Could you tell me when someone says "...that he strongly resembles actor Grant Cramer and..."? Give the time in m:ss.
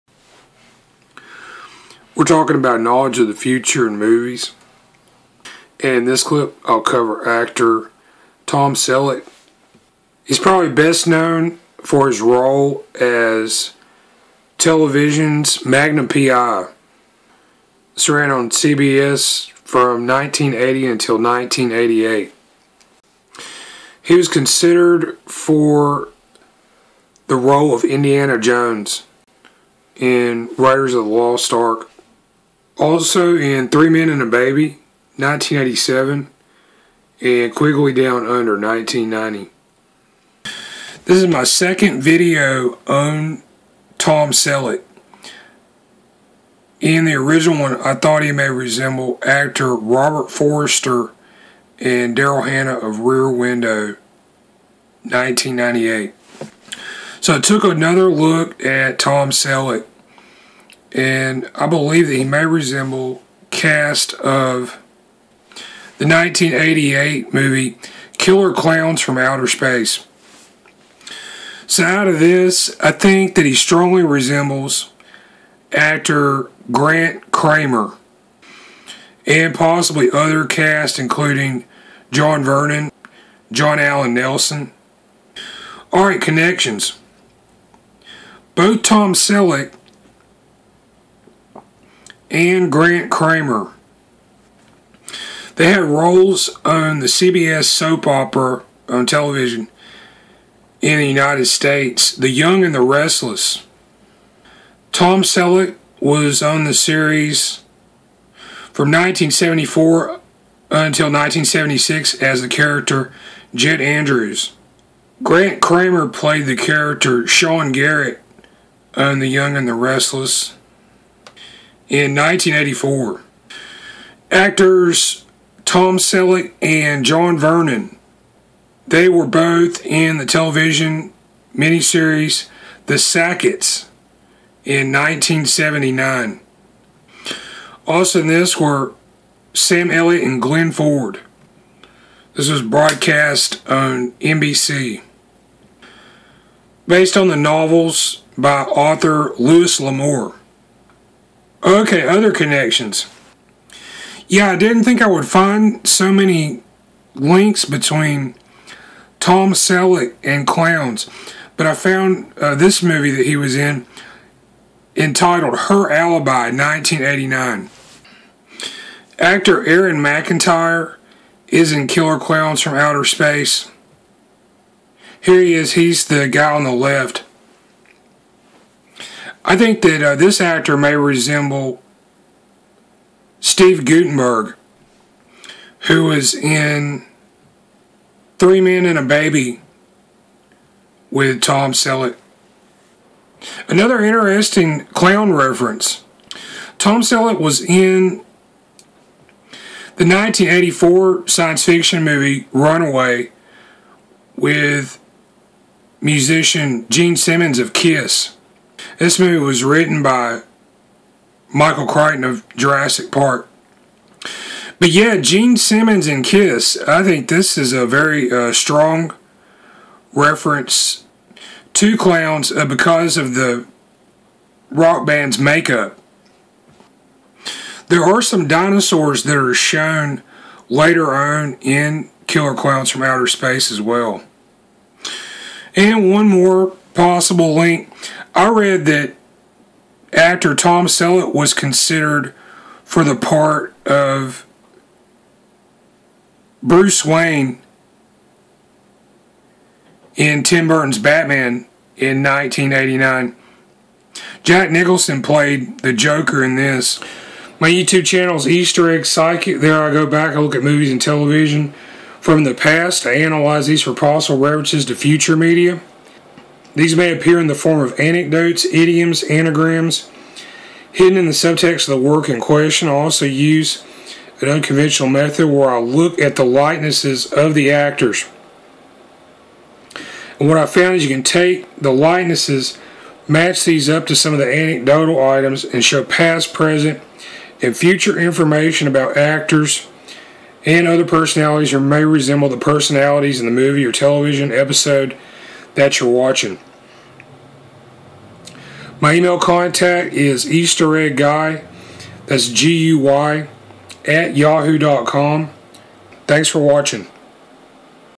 1:13.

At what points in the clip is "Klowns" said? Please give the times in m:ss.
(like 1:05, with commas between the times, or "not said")
1:08, 2:52, 3:52.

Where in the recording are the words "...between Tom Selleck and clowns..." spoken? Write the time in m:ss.
2:37.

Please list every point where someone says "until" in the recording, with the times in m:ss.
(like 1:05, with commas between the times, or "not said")
0:20, 1:50.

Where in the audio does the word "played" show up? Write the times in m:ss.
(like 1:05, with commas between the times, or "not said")
1:56, 4:15.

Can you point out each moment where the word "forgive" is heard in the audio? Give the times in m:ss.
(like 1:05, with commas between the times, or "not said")
not said.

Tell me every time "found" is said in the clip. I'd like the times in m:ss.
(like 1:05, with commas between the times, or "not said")
2:41, 4:40.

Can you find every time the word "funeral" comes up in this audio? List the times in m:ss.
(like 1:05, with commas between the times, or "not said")
not said.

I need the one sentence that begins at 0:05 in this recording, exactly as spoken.
And in this clip, I'll cover actor Tom Selleck.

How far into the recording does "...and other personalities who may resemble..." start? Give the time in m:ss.
4:50.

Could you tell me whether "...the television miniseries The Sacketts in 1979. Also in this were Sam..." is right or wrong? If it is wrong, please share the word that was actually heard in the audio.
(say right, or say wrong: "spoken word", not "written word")
right.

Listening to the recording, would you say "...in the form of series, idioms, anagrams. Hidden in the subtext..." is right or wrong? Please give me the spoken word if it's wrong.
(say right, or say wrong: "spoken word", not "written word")
wrong: "anecdotes", not "series".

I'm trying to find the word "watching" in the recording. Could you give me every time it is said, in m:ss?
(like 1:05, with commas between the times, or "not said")
4:56, 5:06.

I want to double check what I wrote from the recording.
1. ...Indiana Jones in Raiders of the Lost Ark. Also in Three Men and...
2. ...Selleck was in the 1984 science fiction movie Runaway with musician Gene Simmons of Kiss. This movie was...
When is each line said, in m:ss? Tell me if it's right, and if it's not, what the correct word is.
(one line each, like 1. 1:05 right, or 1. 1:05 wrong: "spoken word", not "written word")
1. 0:27 right
2. 3:17 right.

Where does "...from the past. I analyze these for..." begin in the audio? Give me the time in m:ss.
4:22.